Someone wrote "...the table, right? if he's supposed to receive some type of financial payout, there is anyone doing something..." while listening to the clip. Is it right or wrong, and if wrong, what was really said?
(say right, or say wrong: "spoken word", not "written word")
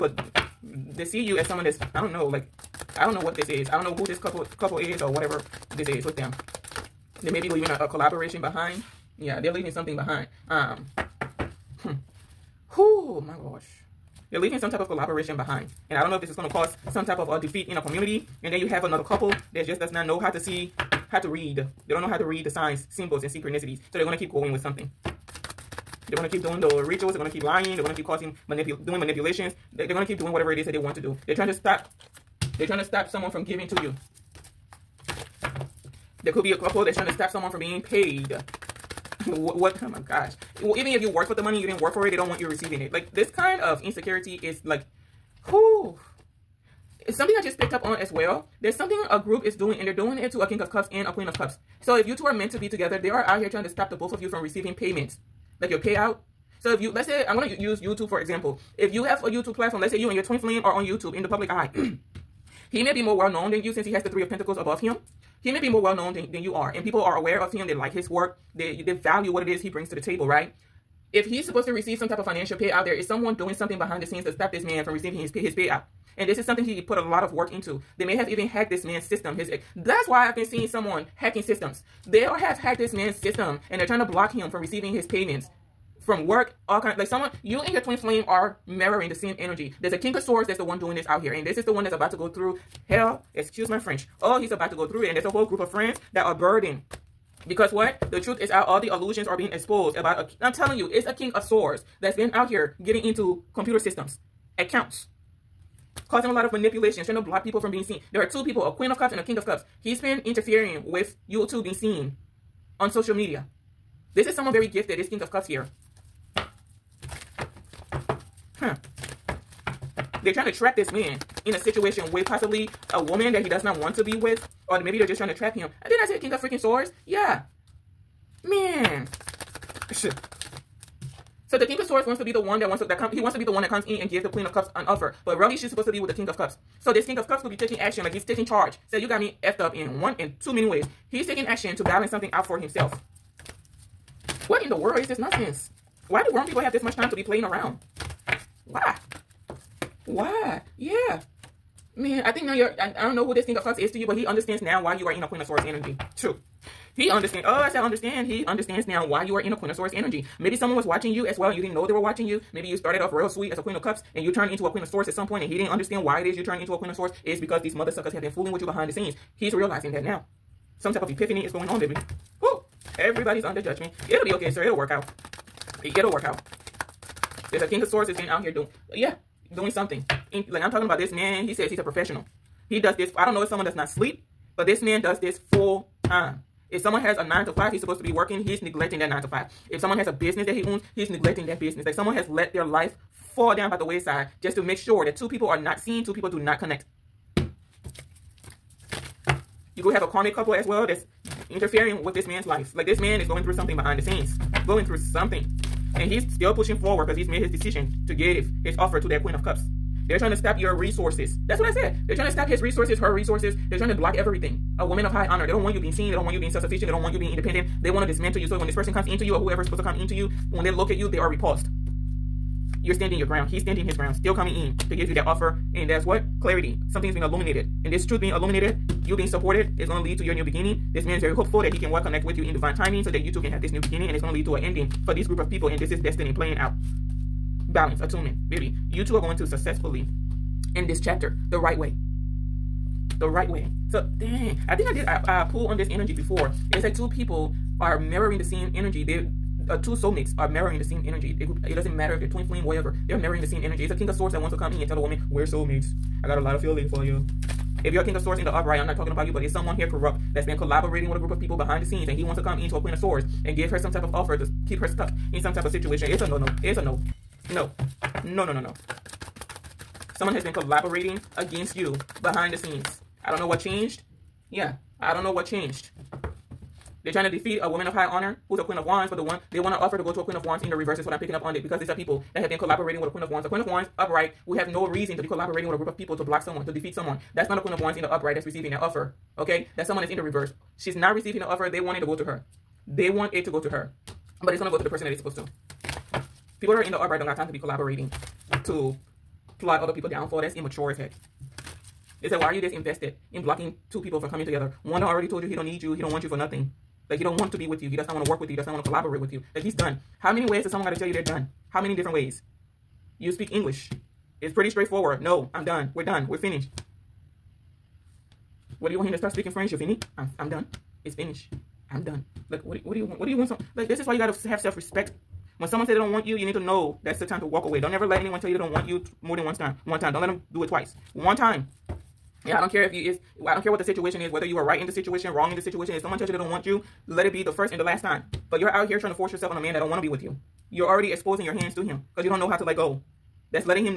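wrong: "someone", not "anyone".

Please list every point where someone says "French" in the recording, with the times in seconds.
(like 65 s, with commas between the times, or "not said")
93 s, 319 s.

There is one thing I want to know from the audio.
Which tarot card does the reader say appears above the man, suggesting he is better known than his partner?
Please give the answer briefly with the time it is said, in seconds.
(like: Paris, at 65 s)
Three of Pentacles, at 64 s.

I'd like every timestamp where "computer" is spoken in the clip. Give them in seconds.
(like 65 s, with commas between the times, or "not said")
103 s.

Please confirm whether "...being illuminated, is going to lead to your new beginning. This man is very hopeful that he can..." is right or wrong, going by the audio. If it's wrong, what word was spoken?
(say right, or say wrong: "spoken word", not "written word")
wrong: "supported", not "illuminated".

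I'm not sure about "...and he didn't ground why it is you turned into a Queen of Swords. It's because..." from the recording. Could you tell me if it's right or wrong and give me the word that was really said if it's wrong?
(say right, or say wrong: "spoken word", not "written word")
wrong: "understand", not "ground".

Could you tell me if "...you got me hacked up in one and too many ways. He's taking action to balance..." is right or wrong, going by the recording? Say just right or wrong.
wrong.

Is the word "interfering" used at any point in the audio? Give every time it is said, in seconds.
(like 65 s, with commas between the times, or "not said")
110 s, 201 s.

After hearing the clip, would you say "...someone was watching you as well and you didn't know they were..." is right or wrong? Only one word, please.
right.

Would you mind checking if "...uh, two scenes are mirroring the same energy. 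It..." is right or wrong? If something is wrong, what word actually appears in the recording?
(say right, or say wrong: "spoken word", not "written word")
wrong: "soulmates", not "scenes".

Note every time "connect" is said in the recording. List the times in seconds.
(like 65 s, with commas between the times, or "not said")
196 s, 231 s.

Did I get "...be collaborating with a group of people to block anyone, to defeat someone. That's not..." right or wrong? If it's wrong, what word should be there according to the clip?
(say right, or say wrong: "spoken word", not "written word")
wrong: "someone", not "anyone".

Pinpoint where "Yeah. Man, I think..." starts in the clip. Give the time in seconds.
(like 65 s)
150 s.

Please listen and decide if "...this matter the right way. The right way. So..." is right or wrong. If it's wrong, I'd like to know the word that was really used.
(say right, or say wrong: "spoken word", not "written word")
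wrong: "chapter", not "matter".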